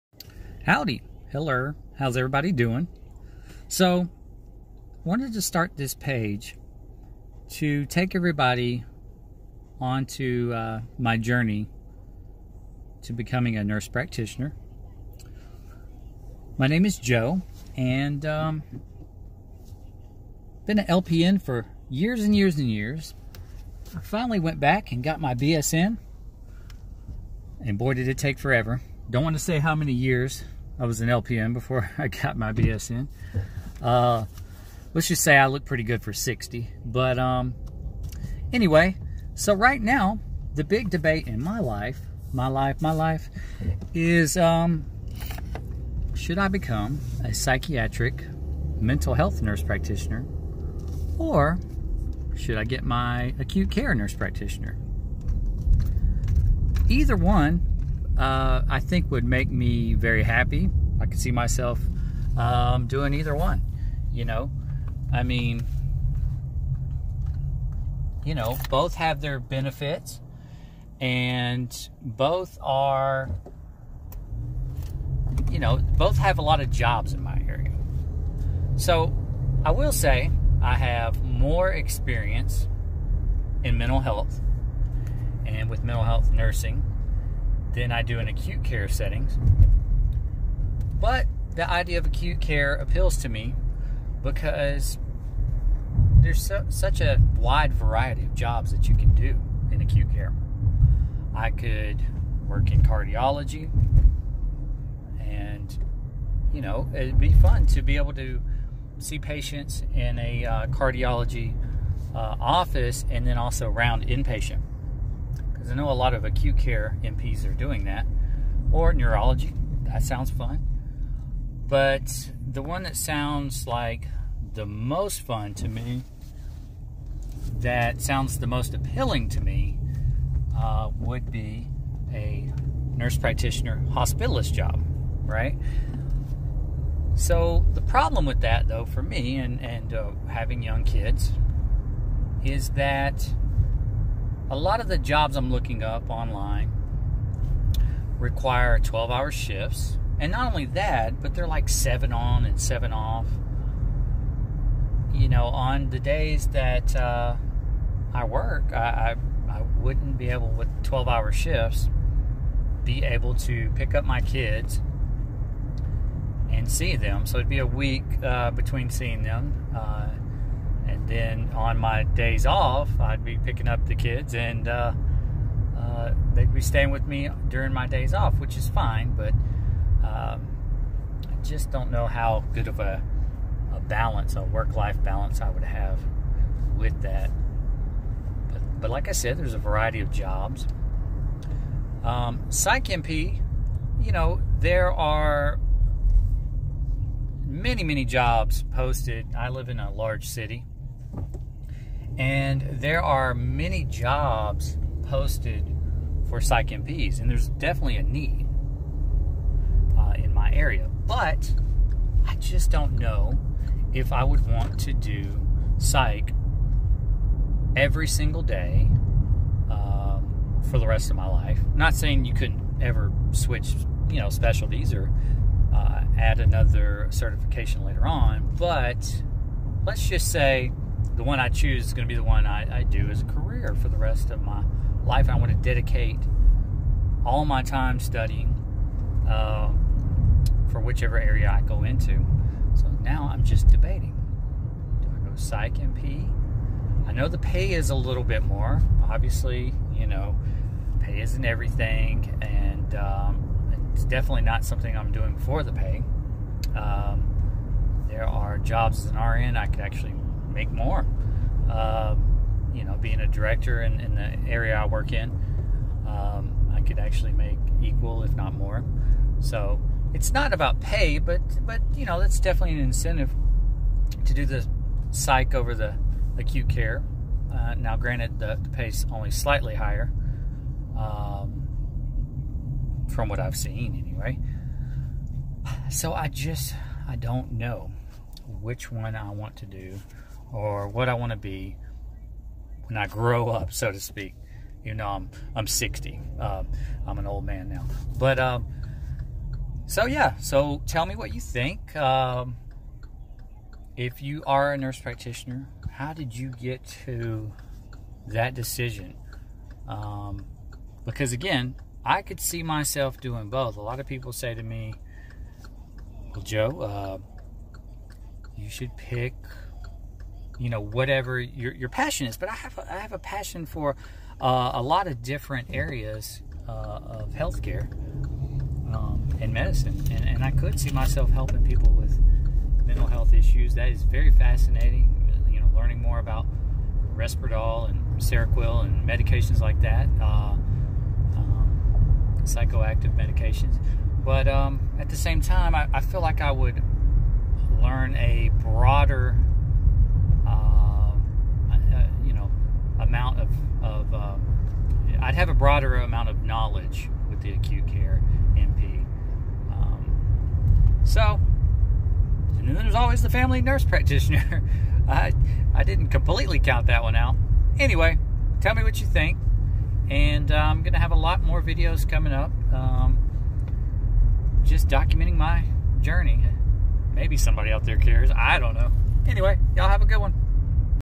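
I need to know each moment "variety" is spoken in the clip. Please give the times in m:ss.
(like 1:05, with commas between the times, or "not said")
1:37, 3:09.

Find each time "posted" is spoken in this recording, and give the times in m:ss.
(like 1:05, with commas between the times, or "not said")
3:18, 3:25.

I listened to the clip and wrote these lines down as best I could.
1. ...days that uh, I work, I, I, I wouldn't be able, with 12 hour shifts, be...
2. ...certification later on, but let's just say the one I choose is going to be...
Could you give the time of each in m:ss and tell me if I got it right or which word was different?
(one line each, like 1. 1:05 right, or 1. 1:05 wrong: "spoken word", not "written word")
1. 2:35 right
2. 3:47 right.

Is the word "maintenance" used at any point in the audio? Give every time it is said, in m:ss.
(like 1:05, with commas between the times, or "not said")
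not said.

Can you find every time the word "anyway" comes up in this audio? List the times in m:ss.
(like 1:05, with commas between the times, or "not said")
0:38, 4:44, 6:07, 6:19.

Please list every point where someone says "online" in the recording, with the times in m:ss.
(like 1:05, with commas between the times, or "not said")
2:26.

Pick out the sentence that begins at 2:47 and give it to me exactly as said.
So it'd be a week uh, between seeing them.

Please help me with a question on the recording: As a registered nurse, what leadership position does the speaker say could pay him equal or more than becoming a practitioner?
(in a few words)
Director.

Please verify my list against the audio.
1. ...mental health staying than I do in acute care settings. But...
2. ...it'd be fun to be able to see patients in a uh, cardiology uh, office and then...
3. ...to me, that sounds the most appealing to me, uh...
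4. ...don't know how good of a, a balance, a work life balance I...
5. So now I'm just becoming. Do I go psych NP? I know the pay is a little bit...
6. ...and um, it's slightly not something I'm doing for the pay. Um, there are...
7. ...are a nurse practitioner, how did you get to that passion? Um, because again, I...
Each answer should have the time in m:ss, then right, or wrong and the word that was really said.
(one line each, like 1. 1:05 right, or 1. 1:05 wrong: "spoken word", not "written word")
1. 1:25 wrong: "nursing", not "staying"
2. 1:46 right
3. 2:05 right
4. 3:01 right
5. 4:02 wrong: "debating", not "becoming"
6. 4:12 wrong: "definitely", not "slightly"
7. 5:04 wrong: "decision", not "passion".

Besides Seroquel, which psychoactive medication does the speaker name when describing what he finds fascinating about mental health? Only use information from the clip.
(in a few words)
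Risperdal.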